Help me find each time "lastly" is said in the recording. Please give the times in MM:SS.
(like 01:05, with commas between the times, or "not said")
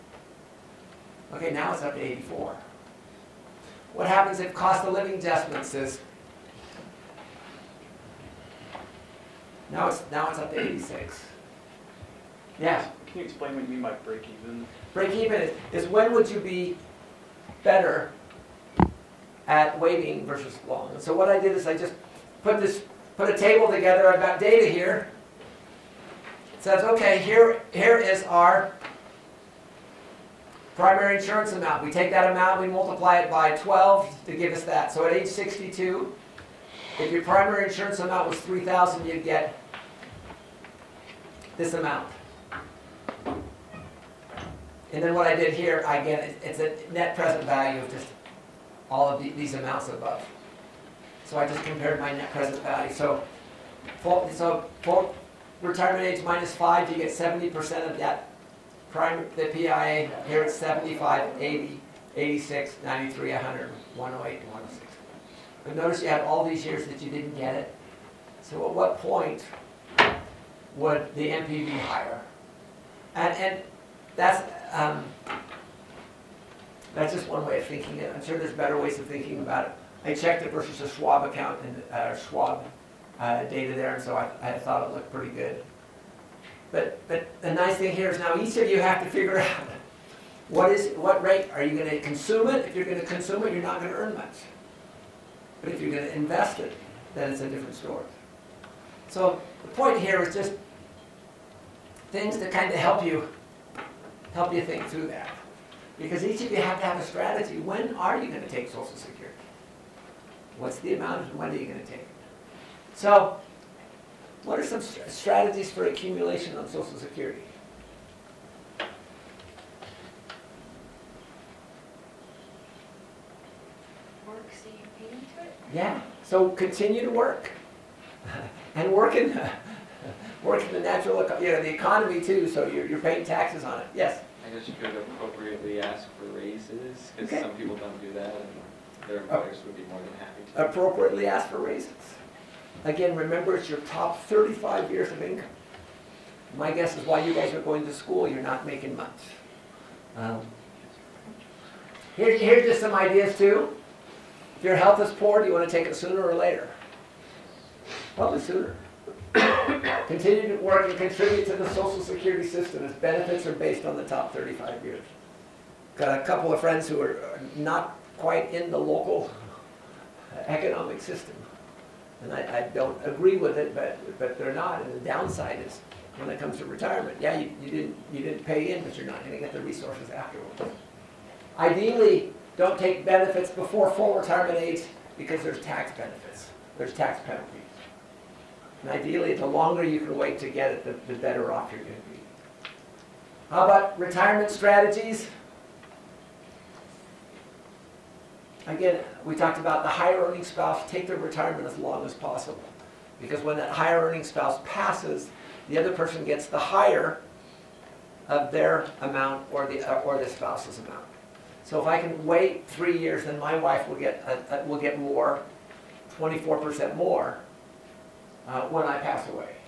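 not said.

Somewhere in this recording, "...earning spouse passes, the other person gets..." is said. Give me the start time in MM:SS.
03:24.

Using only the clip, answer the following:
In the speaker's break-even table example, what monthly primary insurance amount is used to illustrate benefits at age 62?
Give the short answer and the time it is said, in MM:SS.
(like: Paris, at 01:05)
3000, at 00:38.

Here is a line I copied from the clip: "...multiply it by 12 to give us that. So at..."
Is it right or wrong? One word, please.
right.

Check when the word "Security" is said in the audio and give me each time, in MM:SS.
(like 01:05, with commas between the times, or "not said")
01:48, 01:56, 02:42.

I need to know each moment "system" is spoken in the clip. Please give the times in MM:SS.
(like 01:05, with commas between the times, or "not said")
02:42, 02:50.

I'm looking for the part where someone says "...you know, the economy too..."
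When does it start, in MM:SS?
02:11.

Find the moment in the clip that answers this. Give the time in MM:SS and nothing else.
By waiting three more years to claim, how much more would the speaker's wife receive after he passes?
03:36.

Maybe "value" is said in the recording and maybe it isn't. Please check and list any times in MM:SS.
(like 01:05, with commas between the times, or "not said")
00:47, 00:52.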